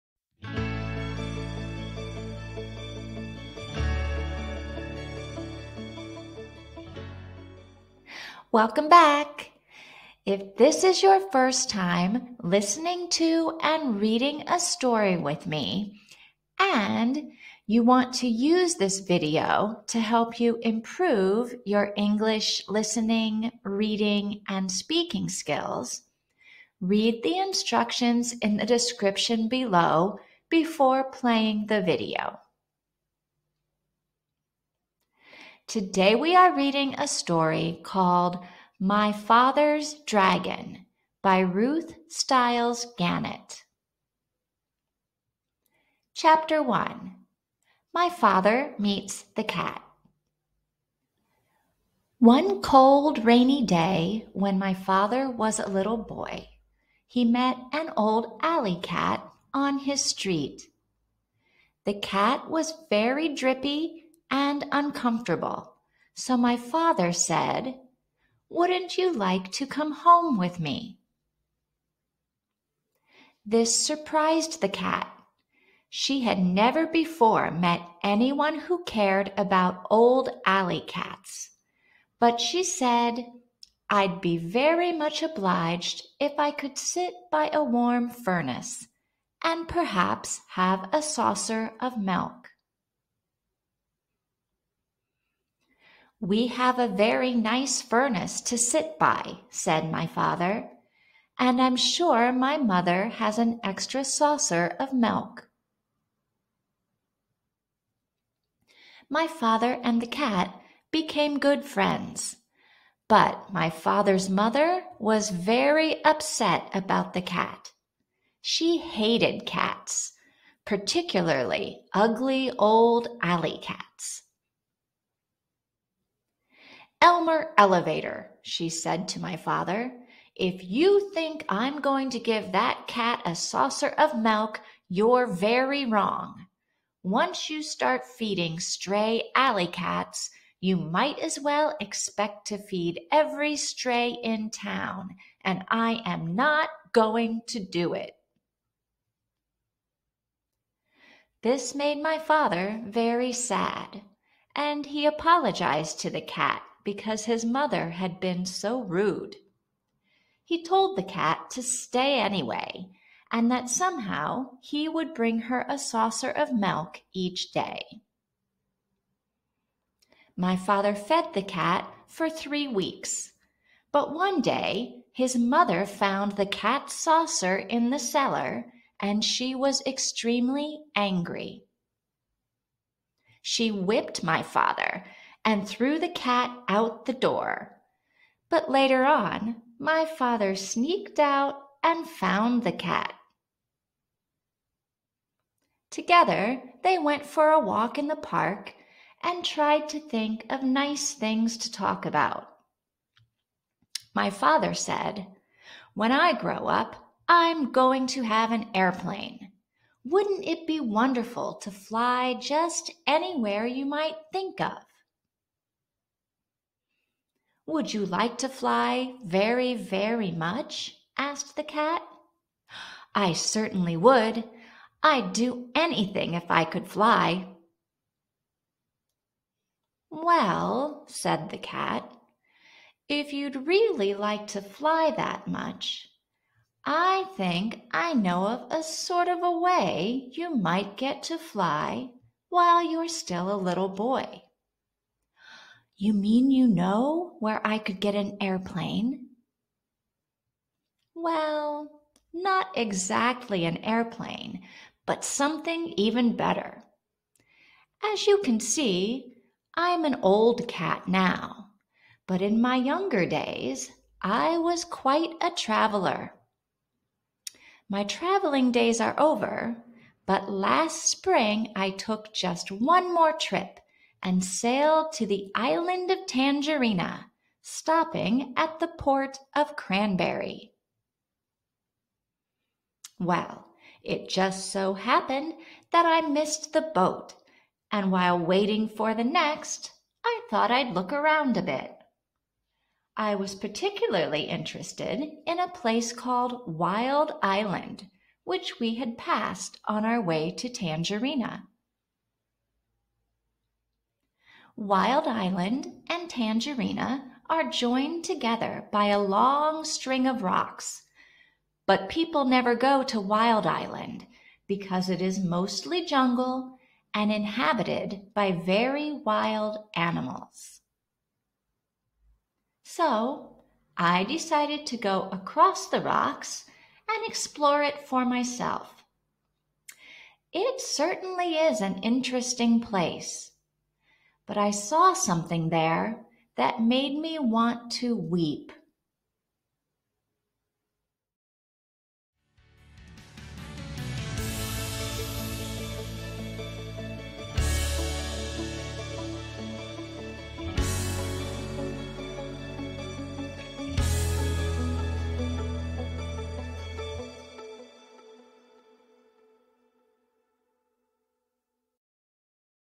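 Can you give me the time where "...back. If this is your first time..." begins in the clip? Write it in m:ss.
0:08.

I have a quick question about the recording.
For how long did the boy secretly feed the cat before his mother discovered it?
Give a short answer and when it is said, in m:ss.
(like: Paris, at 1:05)
3 weeks, at 2:52.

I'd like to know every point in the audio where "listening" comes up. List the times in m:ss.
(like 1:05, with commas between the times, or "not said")
0:12, 0:22.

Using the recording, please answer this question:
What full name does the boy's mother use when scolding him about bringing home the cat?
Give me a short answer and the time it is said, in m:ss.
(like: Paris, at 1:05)
Elmer Elevator, at 2:07.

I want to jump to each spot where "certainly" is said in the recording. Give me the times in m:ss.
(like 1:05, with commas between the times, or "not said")
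3:43, 5:30.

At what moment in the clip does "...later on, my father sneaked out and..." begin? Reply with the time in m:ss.
3:08.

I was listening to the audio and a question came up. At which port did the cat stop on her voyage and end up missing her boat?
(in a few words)
Cranberry.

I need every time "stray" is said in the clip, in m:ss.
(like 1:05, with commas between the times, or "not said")
2:18, 2:23.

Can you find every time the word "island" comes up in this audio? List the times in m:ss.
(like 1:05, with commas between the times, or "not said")
4:35, 4:57, 5:05, 5:13.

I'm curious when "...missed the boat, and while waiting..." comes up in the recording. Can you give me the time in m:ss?
4:46.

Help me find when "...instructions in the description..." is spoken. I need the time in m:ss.
0:27.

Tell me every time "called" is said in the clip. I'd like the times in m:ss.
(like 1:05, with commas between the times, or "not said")
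0:37, 4:56.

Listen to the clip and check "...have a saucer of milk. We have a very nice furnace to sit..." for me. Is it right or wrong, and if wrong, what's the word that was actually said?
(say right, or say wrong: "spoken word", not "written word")
right.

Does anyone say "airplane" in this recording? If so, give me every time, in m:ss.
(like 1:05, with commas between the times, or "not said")
3:28, 4:08, 4:13.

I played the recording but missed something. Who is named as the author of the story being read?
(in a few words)
Ruth Stiles Gannett.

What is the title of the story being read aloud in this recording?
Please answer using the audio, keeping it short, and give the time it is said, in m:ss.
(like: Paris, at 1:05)
My Father's Dragon, at 0:38.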